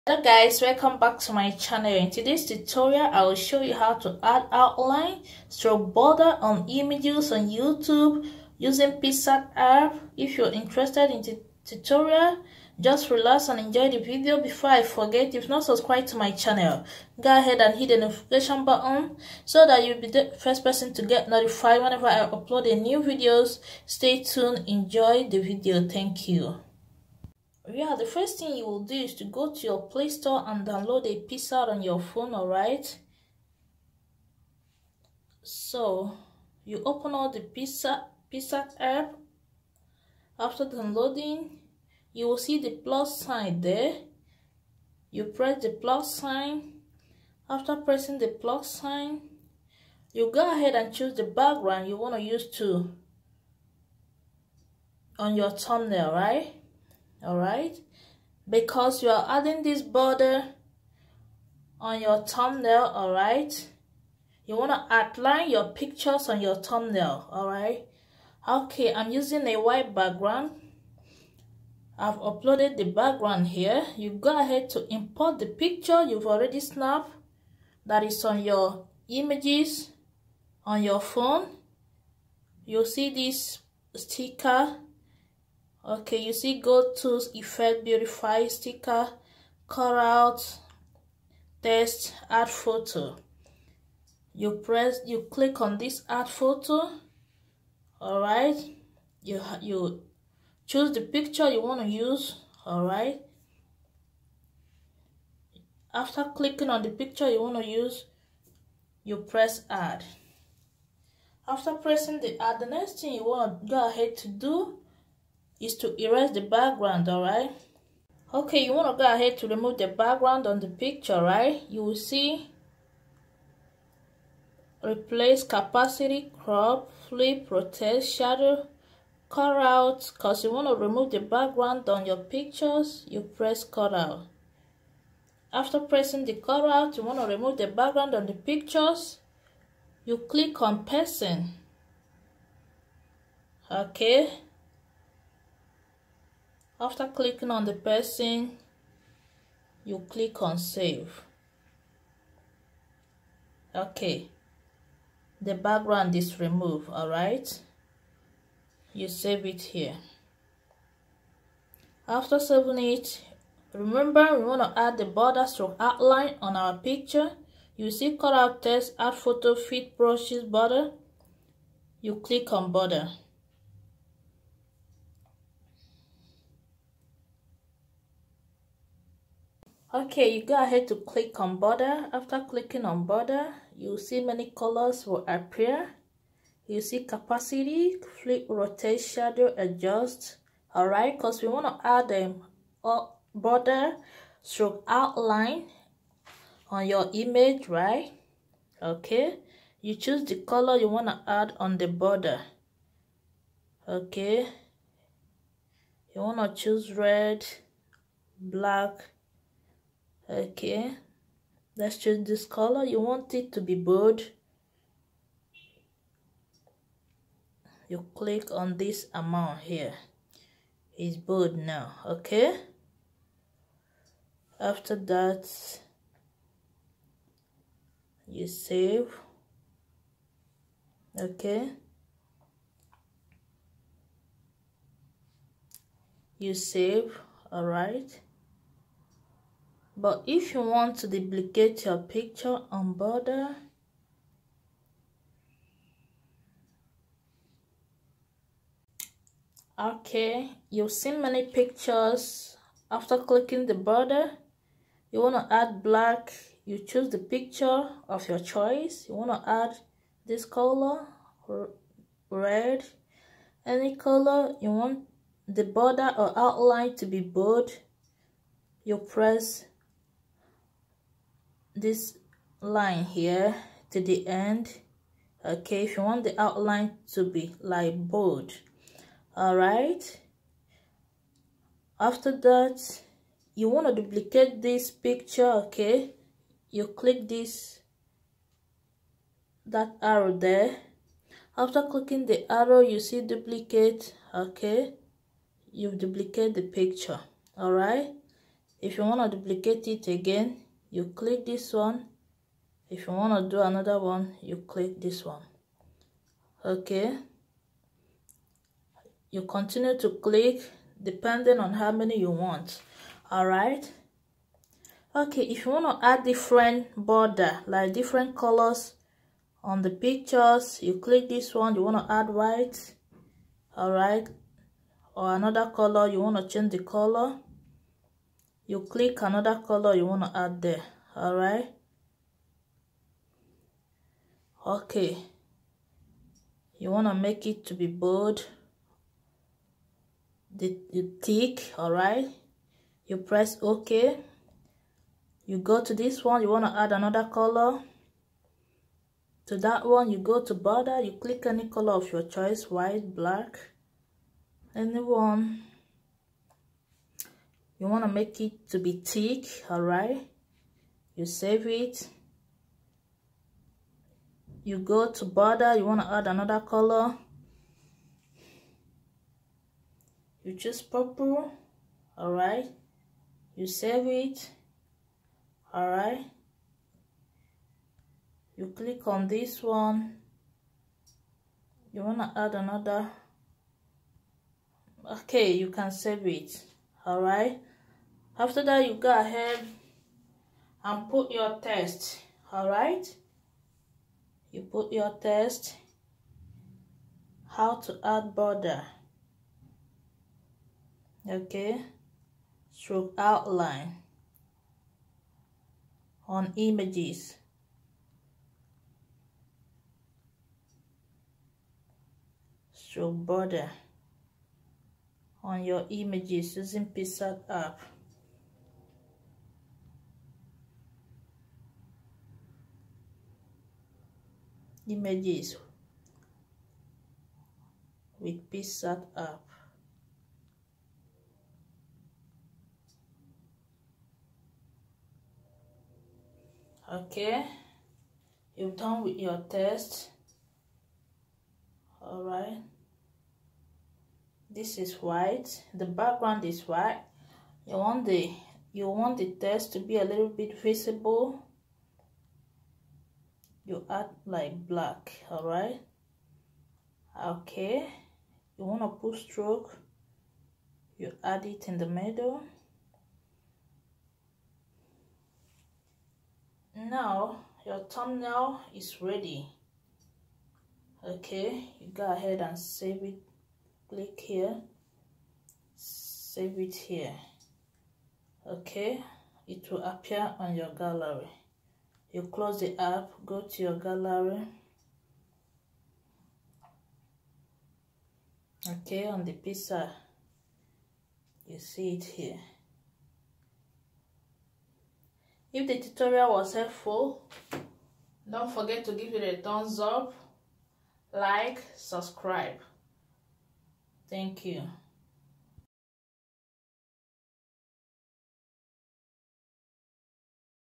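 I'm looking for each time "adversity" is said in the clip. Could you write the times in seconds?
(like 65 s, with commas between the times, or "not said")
not said.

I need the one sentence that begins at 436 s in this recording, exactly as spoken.
Okay, you've done with your test.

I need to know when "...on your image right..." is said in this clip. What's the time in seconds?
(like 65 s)
196 s.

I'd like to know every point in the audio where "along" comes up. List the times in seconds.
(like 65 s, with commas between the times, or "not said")
not said.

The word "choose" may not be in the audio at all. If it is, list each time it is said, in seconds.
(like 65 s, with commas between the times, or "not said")
50 s, 100 s, 199 s, 206 s, 256 s, 370 s.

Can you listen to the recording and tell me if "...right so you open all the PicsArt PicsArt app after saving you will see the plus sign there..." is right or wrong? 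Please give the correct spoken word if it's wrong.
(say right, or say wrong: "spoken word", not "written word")
wrong: "downloading", not "saving".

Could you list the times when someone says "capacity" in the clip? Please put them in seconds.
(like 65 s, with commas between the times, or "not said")
125 s, 187 s.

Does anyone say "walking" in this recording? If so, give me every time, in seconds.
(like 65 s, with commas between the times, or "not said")
not said.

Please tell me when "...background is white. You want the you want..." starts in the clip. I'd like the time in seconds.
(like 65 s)
445 s.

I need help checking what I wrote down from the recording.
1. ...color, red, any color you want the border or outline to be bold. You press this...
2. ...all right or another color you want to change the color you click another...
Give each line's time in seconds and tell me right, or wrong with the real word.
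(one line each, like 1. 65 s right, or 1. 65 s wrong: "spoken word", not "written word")
1. 260 s right
2. 323 s right.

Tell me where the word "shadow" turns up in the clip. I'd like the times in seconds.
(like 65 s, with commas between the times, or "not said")
128 s, 189 s.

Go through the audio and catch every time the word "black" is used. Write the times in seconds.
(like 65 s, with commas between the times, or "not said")
208 s, 255 s, 353 s, 454 s.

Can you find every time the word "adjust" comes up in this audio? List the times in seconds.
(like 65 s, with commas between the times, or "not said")
189 s.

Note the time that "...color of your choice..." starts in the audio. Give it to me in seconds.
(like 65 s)
351 s.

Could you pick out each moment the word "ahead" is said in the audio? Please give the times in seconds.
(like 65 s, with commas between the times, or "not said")
17 s, 50 s, 74 s, 113 s, 119 s, 180 s, 389 s, 472 s.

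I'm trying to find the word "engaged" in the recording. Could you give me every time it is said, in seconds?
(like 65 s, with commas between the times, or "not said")
not said.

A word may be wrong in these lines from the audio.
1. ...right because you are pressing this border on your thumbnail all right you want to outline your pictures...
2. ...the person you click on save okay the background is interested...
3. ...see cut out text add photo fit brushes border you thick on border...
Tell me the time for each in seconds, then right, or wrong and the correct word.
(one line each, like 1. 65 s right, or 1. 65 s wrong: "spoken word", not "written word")
1. 57 s wrong: "adding", not "pressing"
2. 147 s wrong: "removed", not "interested"
3. 167 s wrong: "click", not "thick".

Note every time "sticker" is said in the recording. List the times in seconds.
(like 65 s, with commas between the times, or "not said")
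83 s, 88 s.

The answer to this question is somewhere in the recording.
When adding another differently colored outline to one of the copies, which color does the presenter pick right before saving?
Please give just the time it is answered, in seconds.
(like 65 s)
370 s.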